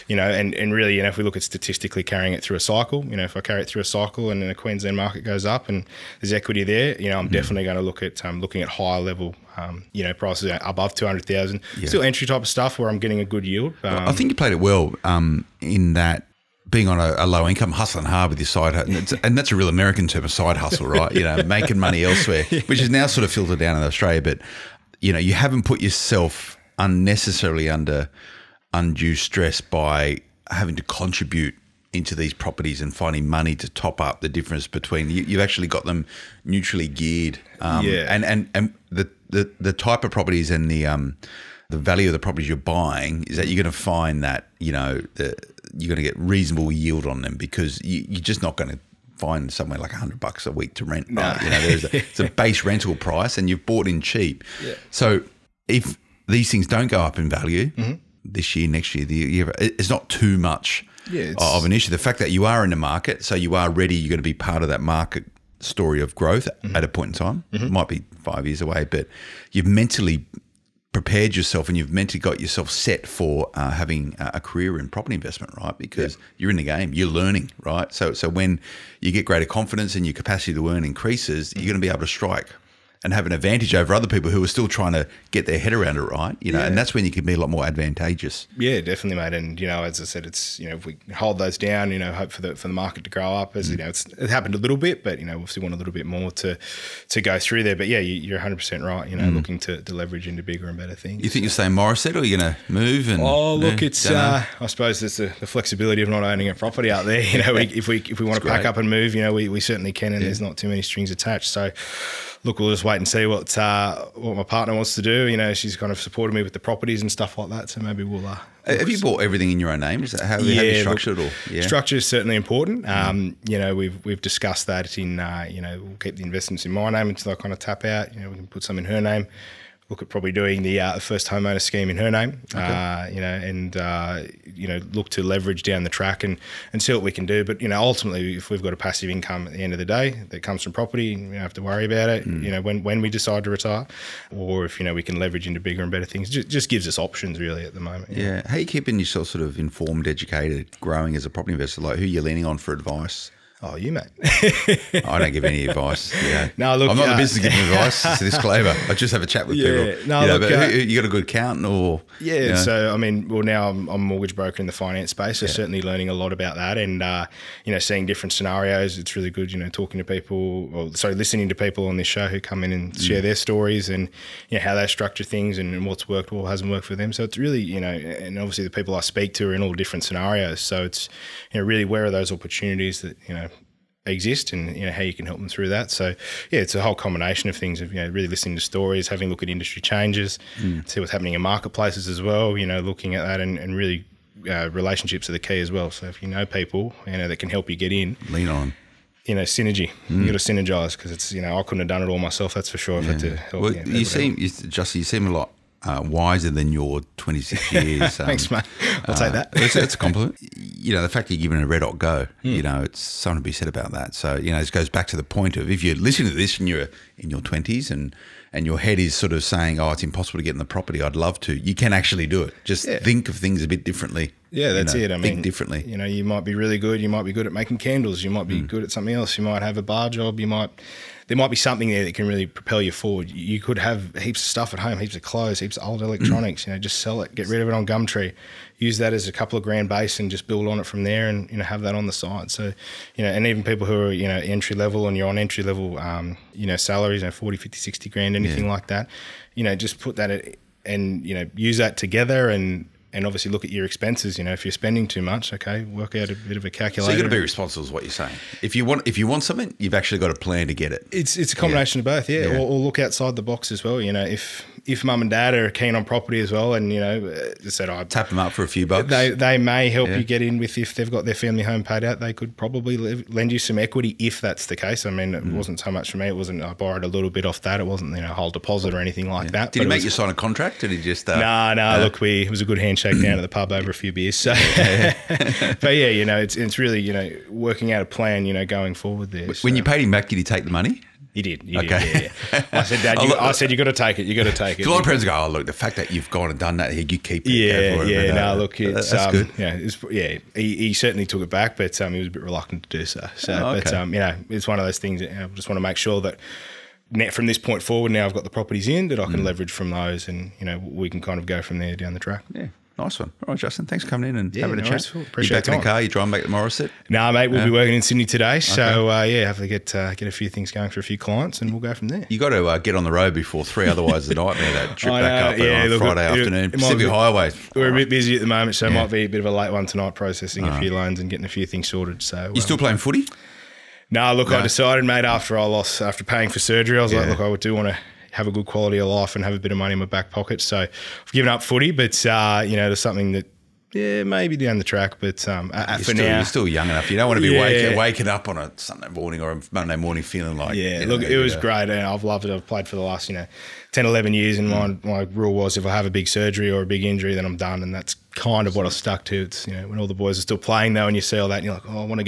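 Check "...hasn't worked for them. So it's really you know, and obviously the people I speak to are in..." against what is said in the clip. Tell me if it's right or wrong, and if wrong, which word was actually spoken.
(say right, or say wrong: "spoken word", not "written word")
right.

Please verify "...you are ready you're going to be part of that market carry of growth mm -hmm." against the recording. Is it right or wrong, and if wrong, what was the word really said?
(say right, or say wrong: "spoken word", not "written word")
wrong: "story", not "carry".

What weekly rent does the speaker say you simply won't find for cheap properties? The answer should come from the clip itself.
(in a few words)
$100.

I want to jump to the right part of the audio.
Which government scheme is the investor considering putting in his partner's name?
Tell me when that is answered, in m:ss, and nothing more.
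2:10.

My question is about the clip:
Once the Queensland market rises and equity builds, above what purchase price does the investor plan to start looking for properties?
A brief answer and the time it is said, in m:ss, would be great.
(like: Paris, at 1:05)
200,000, at 0:10.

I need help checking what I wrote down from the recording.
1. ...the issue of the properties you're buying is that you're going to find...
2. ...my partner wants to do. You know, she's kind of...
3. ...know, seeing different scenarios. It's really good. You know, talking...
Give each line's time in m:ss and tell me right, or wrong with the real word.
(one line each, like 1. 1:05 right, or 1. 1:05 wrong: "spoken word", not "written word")
1. 0:41 wrong: "value", not "issue"
2. 1:54 right
3. 2:47 right.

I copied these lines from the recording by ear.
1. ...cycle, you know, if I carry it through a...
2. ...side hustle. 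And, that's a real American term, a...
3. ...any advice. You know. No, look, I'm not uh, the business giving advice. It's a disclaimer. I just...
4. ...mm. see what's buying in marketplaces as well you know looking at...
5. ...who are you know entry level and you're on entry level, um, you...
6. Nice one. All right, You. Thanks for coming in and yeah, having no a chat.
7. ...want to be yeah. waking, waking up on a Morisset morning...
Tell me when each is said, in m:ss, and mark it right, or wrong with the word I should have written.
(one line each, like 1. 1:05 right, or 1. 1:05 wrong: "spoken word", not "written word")
1. 0:02 right
2. 0:18 right
3. 2:35 right
4. 3:10 wrong: "happening", not "buying"
5. 4:03 right
6. 5:12 wrong: "Justin", not "You"
7. 5:47 wrong: "Sunday", not "Morisset".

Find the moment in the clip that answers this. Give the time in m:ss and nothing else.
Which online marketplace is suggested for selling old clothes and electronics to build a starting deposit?
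3:57.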